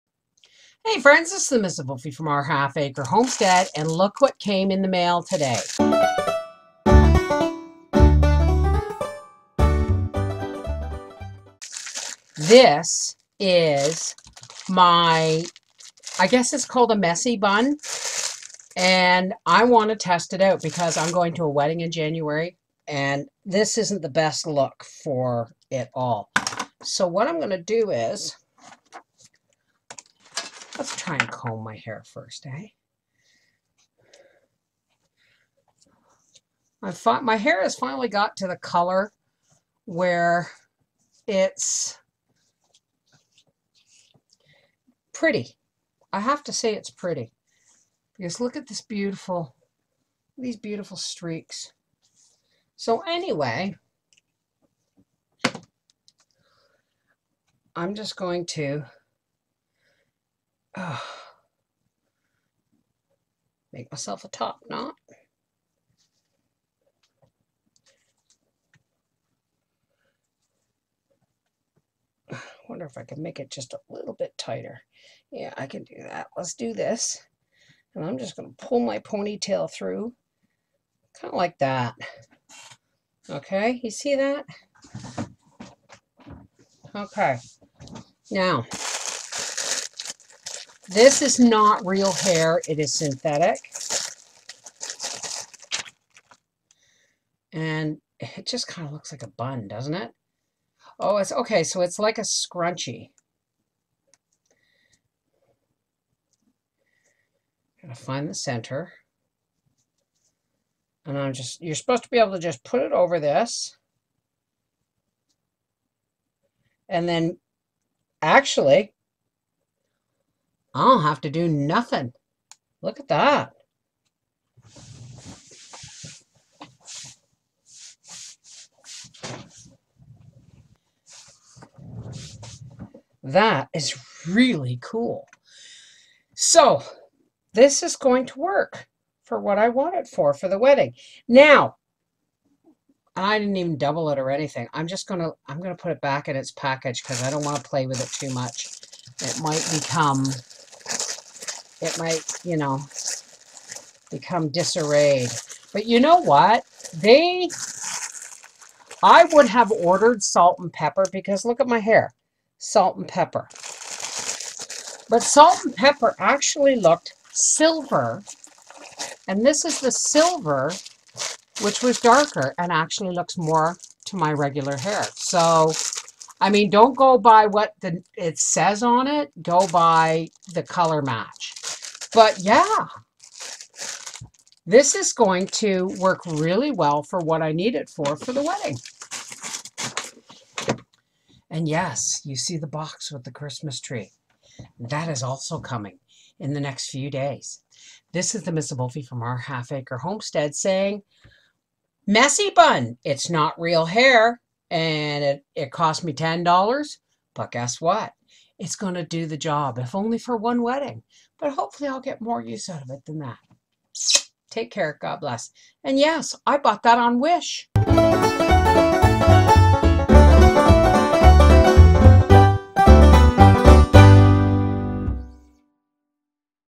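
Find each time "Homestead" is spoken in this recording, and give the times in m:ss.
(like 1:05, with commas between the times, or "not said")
0:03, 3:19.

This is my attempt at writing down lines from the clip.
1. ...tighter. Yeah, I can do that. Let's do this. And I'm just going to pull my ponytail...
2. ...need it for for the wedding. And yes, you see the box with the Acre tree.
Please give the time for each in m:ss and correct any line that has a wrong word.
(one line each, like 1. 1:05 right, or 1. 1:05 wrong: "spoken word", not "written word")
1. 1:14 right
2. 3:07 wrong: "Christmas", not "Acre".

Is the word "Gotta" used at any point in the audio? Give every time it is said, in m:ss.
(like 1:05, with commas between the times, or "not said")
1:47.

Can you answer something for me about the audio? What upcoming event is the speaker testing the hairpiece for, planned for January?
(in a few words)
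A wedding.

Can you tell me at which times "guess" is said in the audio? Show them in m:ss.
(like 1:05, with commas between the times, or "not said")
0:16, 3:27.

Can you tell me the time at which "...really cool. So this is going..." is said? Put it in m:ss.
2:14.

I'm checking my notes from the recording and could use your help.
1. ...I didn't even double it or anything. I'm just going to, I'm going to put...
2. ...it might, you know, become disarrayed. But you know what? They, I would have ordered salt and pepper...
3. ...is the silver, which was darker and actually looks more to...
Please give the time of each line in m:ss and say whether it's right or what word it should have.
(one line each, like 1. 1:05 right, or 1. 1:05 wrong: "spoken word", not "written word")
1. 2:23 right
2. 2:31 right
3. 2:49 right.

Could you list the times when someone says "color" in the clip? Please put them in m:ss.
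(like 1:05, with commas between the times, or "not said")
0:38, 3:00.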